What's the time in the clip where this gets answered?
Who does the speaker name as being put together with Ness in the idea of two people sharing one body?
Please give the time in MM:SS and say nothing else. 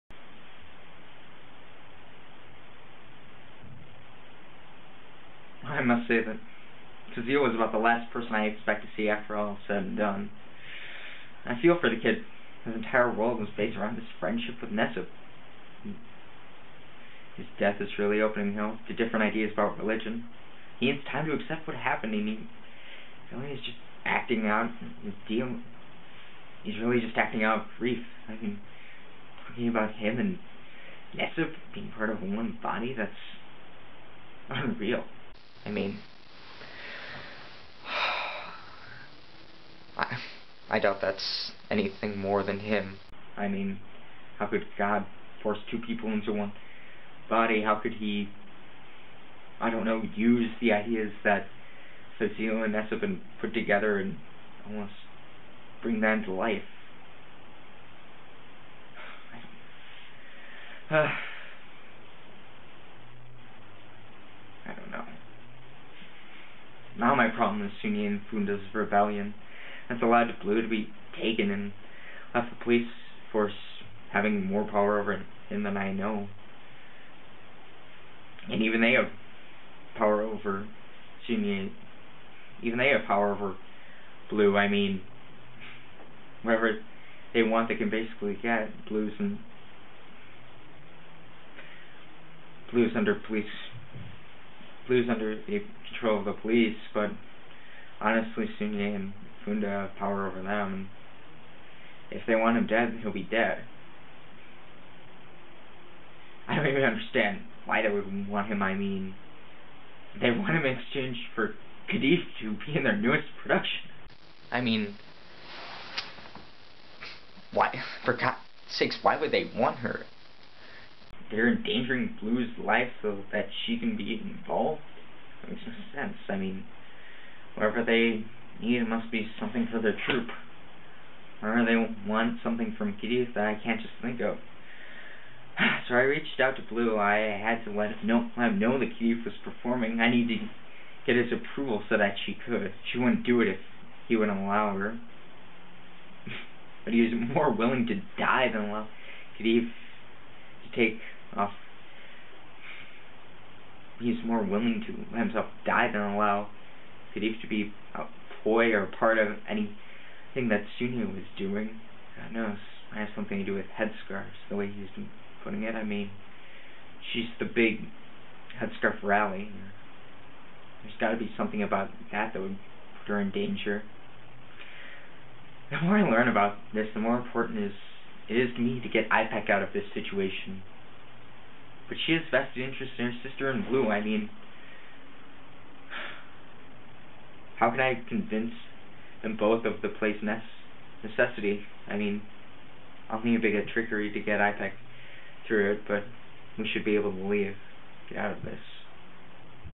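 00:52.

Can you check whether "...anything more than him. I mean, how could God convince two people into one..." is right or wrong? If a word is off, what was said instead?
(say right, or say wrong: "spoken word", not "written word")
wrong: "force", not "convince".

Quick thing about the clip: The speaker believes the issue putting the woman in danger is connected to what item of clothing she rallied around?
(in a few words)
headscarves.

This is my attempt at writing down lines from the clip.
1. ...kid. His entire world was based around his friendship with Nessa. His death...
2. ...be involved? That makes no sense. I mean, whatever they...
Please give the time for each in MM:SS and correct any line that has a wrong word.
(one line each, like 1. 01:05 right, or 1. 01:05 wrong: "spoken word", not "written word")
1. 00:11 right
2. 02:03 right.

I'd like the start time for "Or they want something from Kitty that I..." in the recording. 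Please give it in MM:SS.
02:11.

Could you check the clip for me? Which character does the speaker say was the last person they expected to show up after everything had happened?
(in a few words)
Kazuya.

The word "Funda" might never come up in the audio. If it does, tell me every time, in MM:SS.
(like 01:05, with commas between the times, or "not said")
01:08, 01:39.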